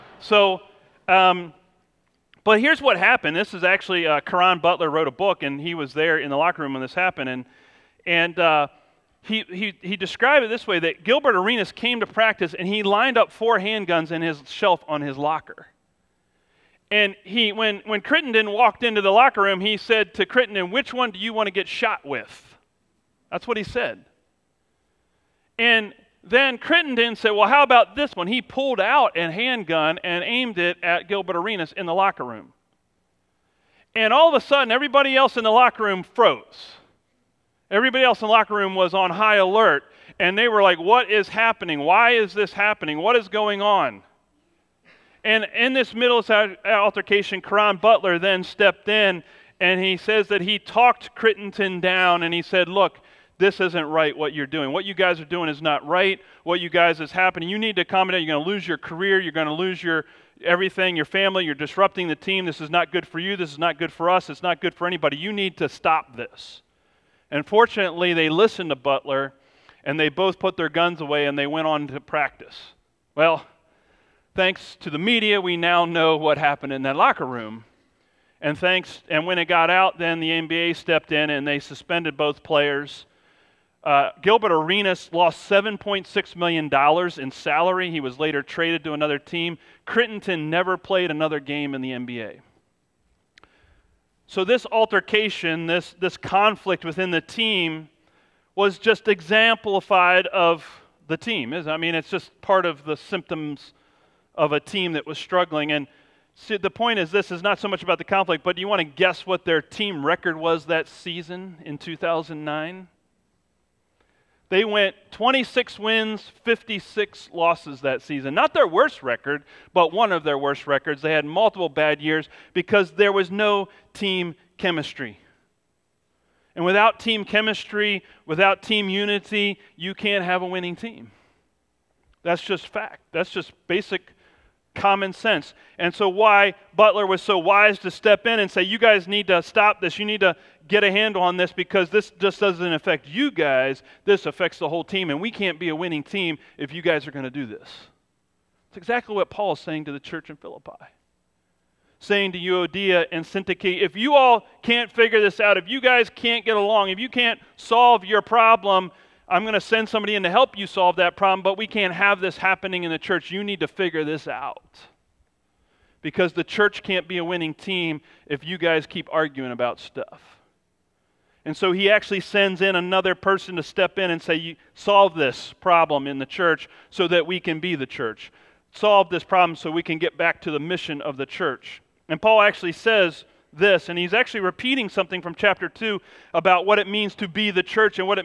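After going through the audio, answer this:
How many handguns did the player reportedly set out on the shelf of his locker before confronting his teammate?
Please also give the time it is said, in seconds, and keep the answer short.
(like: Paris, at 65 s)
4, at 13 s.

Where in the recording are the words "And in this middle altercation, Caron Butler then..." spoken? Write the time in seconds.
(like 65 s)
45 s.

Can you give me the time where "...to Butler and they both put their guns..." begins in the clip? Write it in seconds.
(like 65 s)
68 s.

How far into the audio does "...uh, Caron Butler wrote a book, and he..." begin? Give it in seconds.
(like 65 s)
4 s.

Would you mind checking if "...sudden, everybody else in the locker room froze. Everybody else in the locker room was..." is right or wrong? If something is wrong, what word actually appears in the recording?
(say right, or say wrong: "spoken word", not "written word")
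right.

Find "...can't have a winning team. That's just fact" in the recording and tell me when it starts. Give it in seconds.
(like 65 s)
129 s.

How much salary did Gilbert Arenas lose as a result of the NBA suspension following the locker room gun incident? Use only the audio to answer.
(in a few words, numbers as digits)
$7.6 million.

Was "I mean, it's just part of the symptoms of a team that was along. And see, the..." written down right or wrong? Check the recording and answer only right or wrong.
wrong.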